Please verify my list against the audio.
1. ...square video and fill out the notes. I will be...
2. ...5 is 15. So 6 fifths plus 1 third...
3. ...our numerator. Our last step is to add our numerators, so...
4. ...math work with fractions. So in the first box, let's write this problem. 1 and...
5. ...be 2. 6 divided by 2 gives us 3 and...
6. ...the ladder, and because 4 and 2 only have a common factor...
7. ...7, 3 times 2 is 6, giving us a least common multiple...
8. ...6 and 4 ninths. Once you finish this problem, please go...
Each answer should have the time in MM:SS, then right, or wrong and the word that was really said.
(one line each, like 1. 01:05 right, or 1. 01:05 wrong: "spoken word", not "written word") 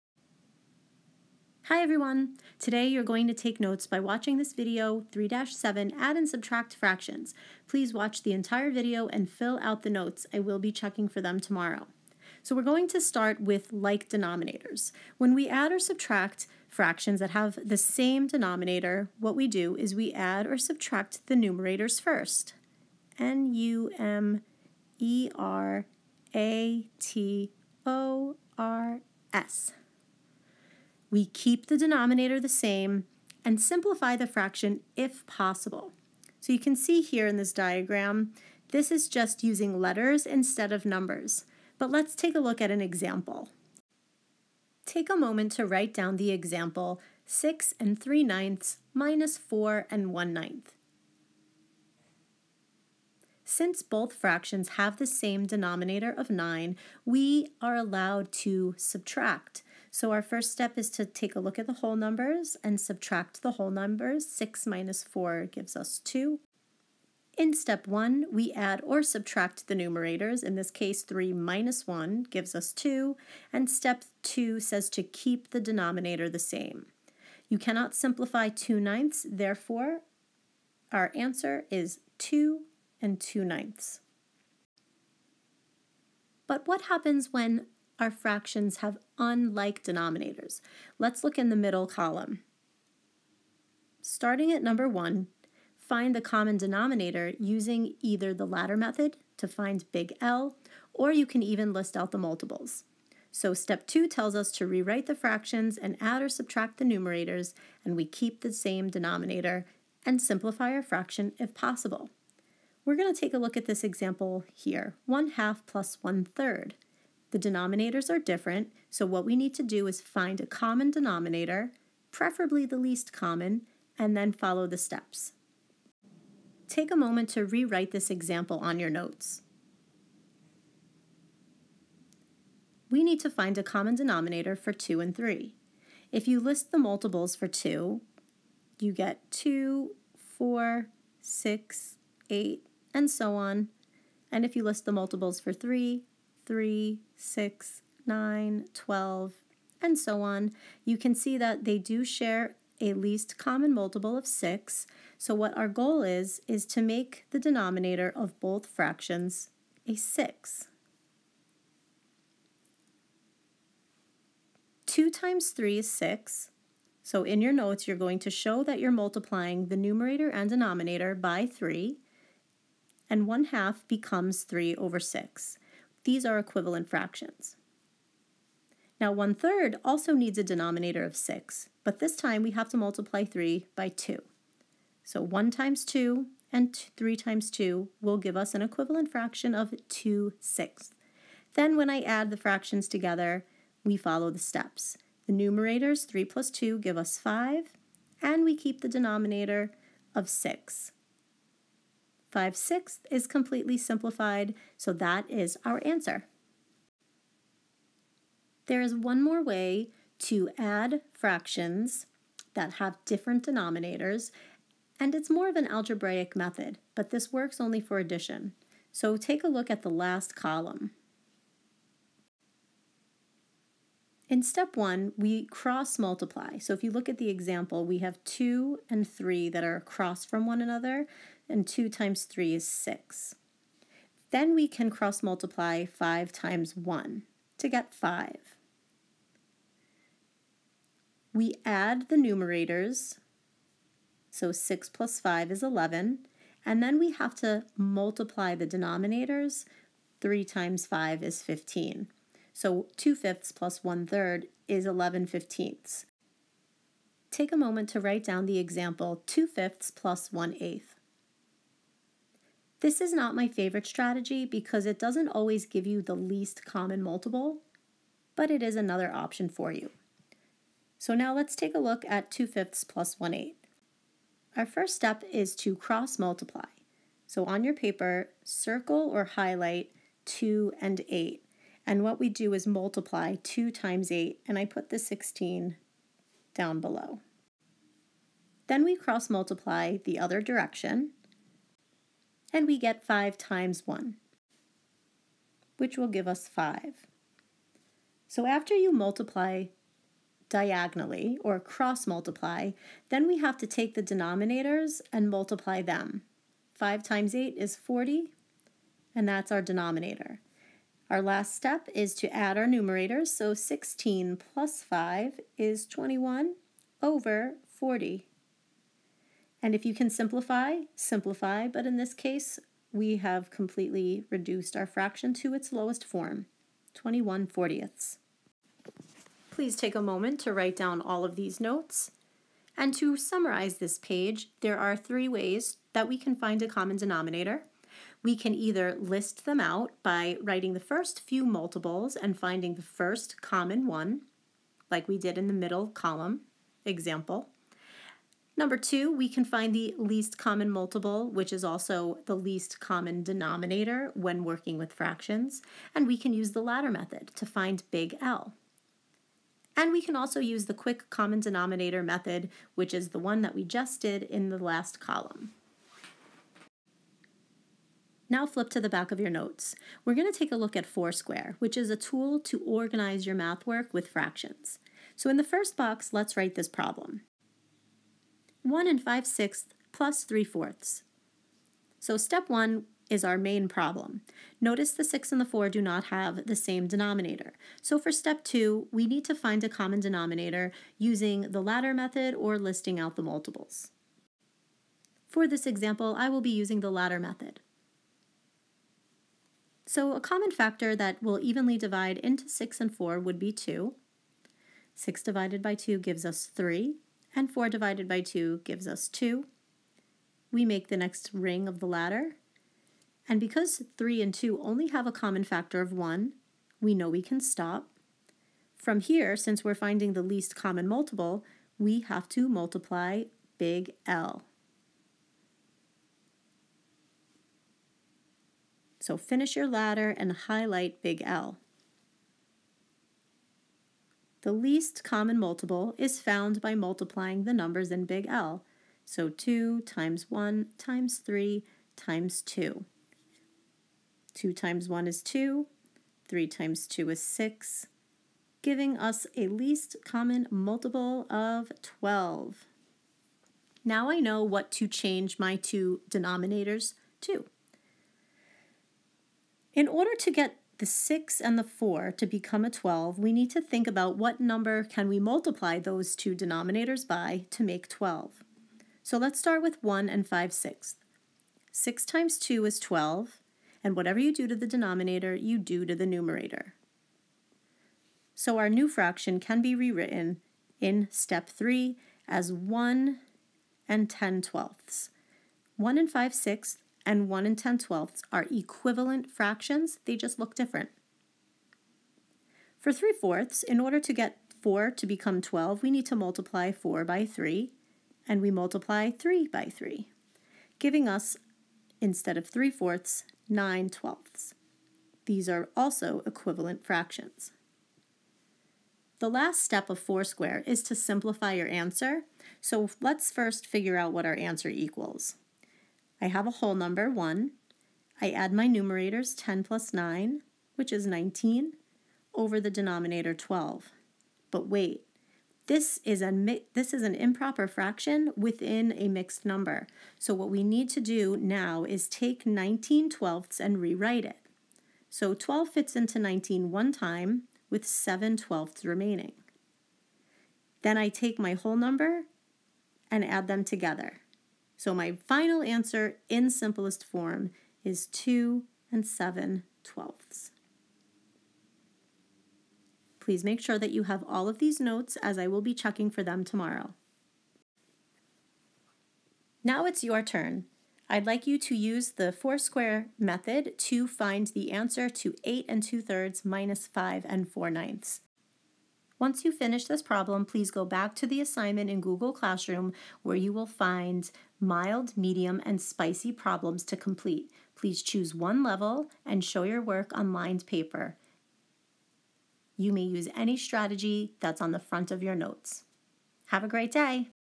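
1. 00:08 wrong: "entire", not "square"
2. 04:10 wrong: "2", not "6"
3. 05:09 wrong: "denominator", not "numerator"
4. 06:13 right
5. 06:43 right
6. 06:51 wrong: "3", not "4"
7. 07:25 wrong: "2", not "7"
8. 09:26 wrong: "5", not "6".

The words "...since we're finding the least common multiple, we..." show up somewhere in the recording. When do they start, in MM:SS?
06:59.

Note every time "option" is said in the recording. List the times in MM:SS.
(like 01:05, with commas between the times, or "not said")
04:29.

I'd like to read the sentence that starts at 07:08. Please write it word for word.
So finish your ladder and highlight big L.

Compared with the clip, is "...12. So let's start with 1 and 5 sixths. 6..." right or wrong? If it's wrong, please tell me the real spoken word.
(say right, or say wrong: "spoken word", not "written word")
right.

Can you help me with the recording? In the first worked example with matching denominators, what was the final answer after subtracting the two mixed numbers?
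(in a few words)
2 and 2/9.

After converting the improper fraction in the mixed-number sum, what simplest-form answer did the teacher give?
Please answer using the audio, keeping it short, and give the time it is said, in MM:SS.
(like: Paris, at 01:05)
2 and 7/12, at 09:08.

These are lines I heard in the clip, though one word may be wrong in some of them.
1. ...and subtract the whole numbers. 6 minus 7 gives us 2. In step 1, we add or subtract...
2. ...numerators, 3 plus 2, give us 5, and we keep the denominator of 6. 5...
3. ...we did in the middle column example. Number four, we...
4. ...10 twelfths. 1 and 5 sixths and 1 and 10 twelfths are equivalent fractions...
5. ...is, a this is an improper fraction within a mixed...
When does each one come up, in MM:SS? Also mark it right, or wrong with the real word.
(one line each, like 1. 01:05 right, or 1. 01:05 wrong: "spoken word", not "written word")
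1. 01:02 wrong: "4", not "7"
2. 03:15 right
3. 05:45 wrong: "two", not "four"
4. 08:04 right
5. 08:46 right.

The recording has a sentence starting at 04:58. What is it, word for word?
So after you multiply diagonally or cross multiply, then we have to take the denominators and multiply them.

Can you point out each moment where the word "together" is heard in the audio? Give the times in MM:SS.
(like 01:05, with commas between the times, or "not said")
03:12, 09:03.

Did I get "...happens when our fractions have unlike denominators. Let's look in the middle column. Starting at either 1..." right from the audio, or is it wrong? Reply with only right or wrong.
wrong.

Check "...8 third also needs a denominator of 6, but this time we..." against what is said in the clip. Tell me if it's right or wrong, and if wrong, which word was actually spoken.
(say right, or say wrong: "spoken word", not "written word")
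wrong: "1", not "8".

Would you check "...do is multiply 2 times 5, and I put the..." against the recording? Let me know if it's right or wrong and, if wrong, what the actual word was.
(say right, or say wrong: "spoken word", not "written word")
wrong: "8", not "5".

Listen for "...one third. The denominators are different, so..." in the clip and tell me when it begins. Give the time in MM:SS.
01:56.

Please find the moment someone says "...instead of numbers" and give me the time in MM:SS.
00:40.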